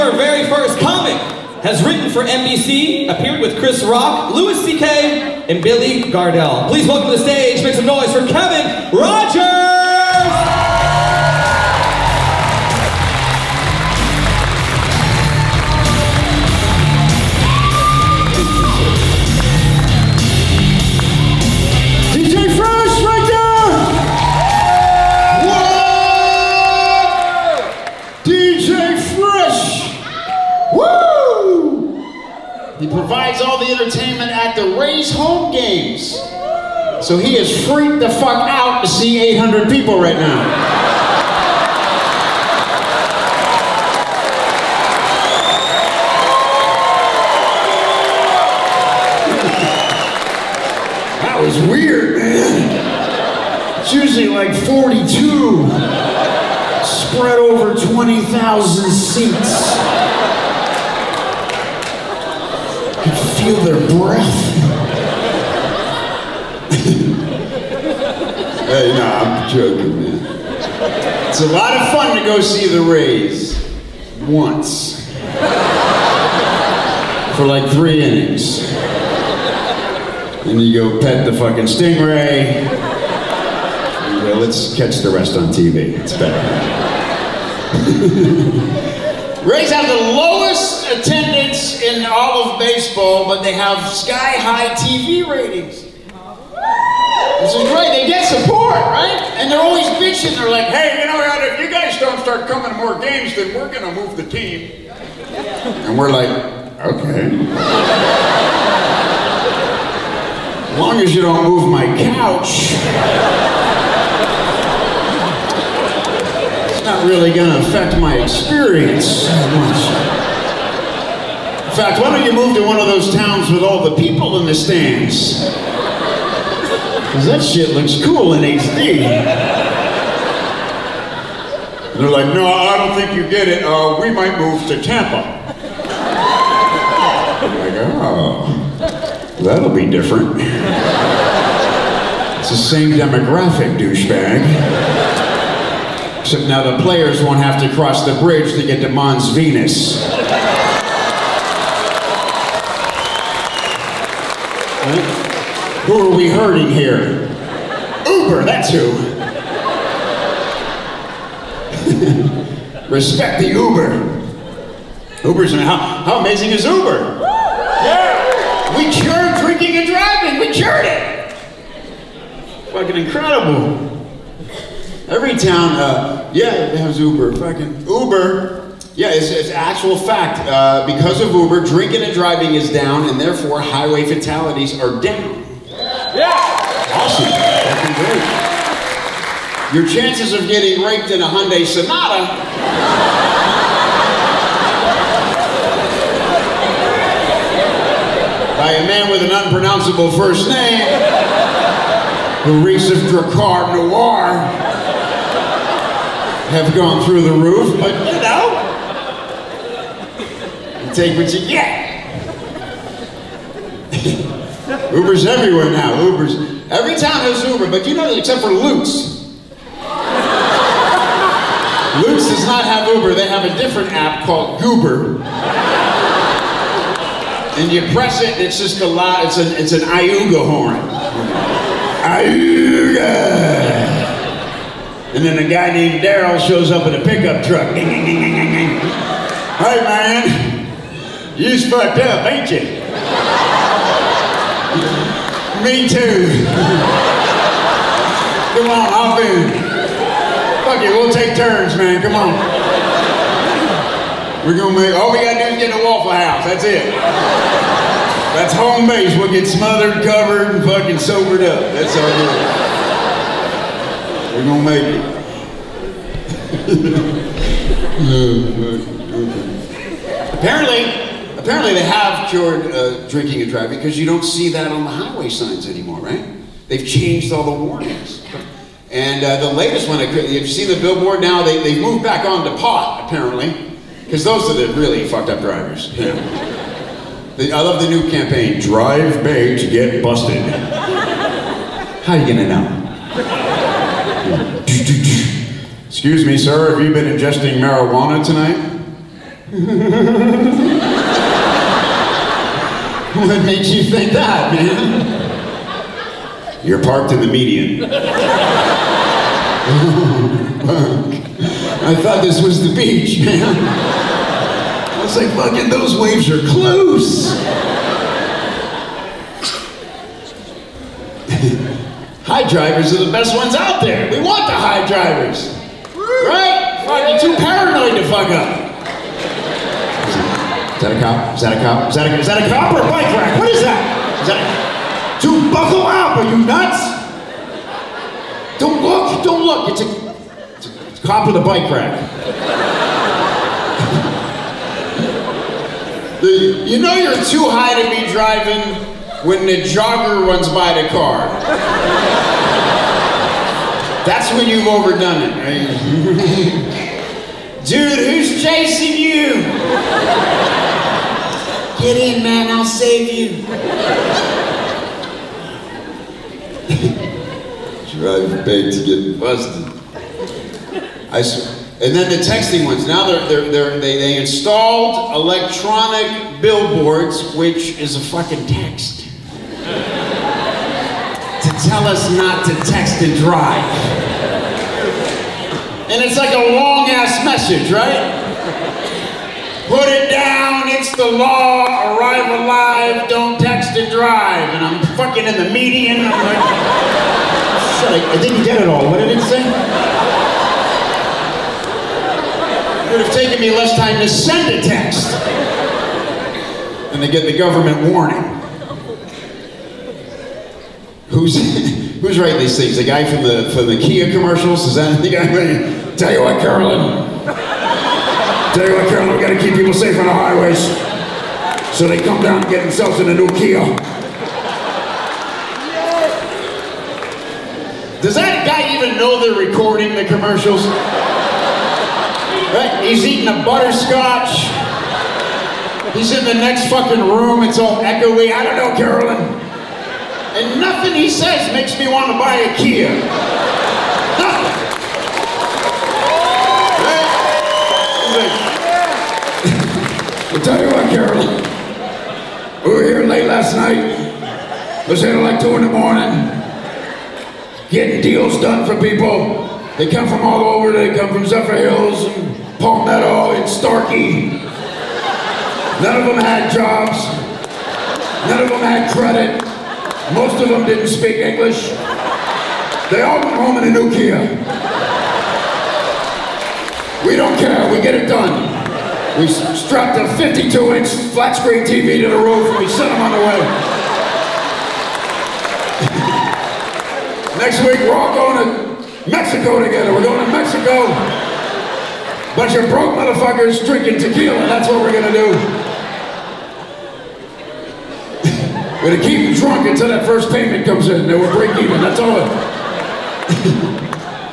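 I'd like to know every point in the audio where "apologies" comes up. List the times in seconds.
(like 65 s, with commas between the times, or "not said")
not said.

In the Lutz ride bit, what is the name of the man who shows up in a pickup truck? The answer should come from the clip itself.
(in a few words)
Daryl.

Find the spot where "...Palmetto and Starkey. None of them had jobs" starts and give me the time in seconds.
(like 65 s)
462 s.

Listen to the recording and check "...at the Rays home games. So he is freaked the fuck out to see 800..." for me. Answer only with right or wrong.
right.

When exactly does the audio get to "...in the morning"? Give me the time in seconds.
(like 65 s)
455 s.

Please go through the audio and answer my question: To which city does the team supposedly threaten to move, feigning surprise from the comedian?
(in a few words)
Tampa.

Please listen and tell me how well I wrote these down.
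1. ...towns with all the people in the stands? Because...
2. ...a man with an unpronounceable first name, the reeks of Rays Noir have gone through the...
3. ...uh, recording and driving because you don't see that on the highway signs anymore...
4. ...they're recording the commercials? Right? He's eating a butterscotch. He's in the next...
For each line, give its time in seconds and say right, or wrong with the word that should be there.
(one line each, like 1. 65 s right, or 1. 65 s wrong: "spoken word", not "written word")
1. 123 s right
2. 198 s wrong: "Drakkar", not "Rays"
3. 272 s wrong: "drinking", not "recording"
4. 429 s right.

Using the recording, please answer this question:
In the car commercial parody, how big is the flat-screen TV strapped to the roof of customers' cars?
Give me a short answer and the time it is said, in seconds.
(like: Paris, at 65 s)
52-inch, at 480 s.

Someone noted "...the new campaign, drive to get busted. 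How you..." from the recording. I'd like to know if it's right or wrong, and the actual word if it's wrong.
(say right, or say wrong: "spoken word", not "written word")
right.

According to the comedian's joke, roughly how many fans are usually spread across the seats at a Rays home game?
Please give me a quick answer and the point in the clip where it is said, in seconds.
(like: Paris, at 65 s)
42, at 54 s.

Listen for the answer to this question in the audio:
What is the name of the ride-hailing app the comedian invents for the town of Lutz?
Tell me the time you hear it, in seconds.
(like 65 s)
224 s.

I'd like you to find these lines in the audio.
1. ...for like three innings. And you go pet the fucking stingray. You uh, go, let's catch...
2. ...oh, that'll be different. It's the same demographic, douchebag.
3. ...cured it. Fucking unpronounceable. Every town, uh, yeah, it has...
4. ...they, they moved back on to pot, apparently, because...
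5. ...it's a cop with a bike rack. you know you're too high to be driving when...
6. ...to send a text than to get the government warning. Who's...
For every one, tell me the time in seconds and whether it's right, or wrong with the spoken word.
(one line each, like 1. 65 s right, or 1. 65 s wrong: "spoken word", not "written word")
1. 77 s right
2. 138 s right
3. 170 s wrong: "incredible", not "unpronounceable"
4. 281 s right
5. 340 s right
6. 404 s right.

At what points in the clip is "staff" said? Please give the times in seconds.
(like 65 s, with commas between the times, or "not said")
not said.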